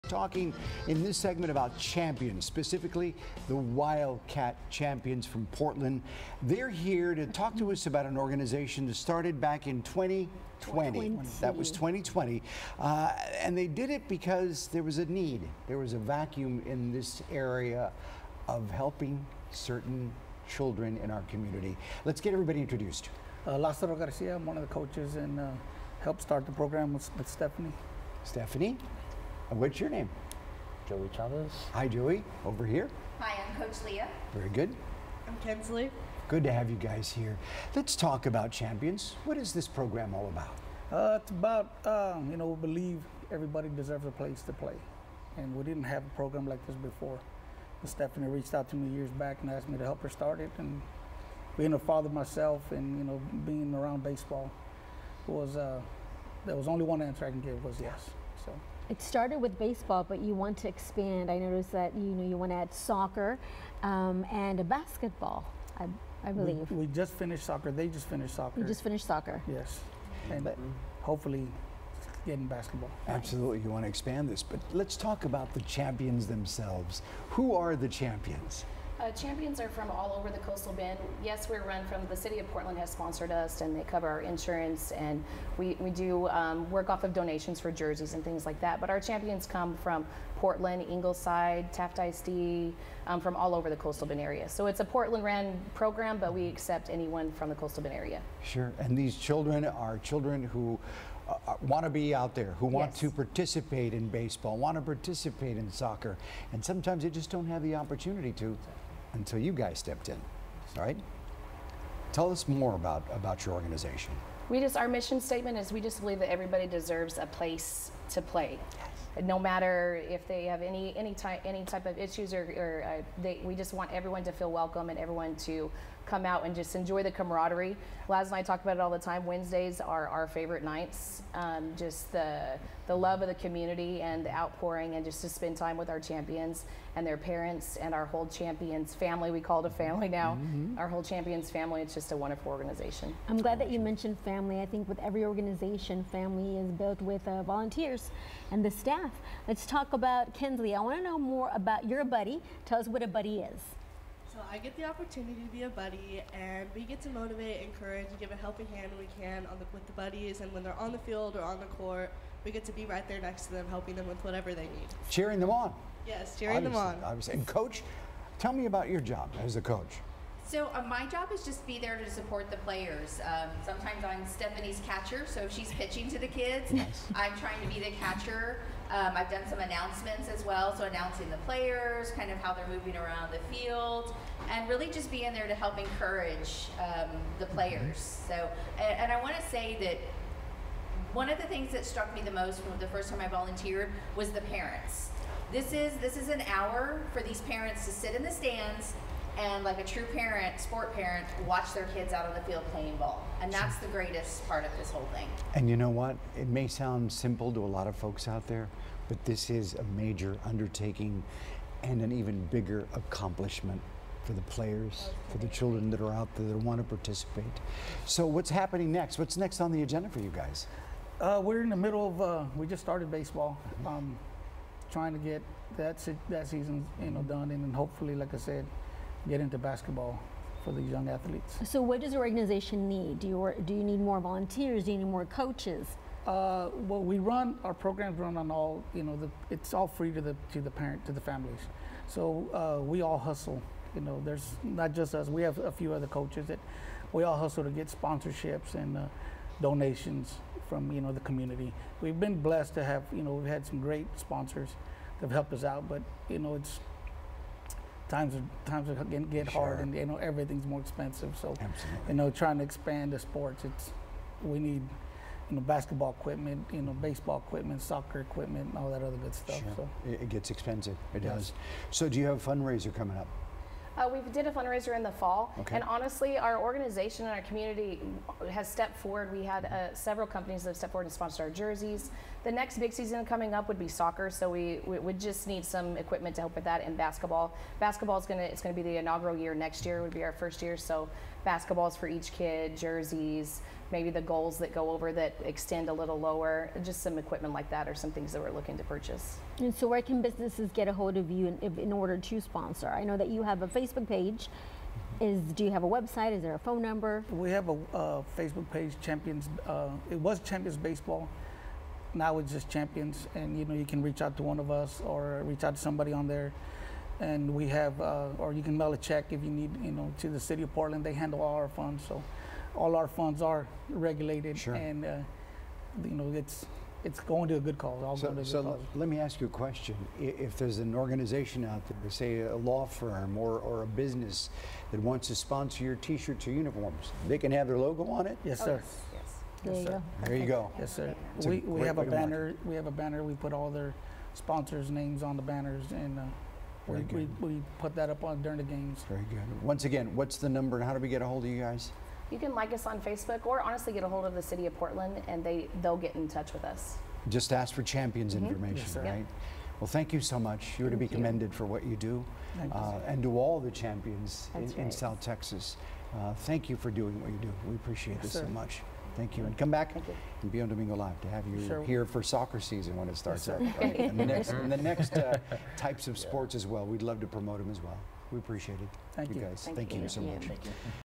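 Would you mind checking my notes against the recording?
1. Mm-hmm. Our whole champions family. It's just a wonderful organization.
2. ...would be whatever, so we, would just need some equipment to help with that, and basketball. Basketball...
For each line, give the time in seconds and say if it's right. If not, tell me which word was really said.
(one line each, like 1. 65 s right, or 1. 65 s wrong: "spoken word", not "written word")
1. 140 s right
2. 283 s wrong: "soccer", not "whatever".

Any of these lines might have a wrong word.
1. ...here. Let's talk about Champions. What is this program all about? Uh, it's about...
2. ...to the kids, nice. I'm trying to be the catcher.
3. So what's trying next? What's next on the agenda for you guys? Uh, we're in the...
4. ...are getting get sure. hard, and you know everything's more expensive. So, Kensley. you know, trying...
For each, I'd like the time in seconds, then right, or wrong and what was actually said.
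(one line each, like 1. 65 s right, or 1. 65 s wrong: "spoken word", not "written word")
1. 37 s right
2. 176 s right
3. 218 s wrong: "happening", not "trying"
4. 258 s wrong: "Absolutely", not "Kensley".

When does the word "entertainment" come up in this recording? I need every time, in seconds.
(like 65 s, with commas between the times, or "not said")
not said.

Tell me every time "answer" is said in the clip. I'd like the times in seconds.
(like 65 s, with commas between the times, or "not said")
57 s.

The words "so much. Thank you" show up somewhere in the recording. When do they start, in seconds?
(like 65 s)
368 s.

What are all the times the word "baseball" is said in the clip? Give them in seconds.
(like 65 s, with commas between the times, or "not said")
54 s, 59 s, 104 s, 223 s, 266 s, 310 s.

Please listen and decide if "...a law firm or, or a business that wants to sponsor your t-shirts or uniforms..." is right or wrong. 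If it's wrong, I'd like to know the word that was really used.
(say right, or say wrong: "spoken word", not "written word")
right.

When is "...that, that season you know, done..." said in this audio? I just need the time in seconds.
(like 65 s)
225 s.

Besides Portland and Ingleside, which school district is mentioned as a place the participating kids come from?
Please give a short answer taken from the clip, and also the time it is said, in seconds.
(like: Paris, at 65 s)
Taft ISD, at 91 s.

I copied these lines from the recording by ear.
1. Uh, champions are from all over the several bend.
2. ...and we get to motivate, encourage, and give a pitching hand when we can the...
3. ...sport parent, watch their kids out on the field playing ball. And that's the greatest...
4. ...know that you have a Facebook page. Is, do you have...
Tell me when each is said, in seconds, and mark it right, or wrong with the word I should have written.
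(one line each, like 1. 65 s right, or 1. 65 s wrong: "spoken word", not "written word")
1. 79 s wrong: "coastal", not "several"
2. 156 s wrong: "helping", not "pitching"
3. 200 s right
4. 303 s right.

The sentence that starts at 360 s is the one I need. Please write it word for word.
You're thank to be commended for what you do uh, and to all the champions in, right.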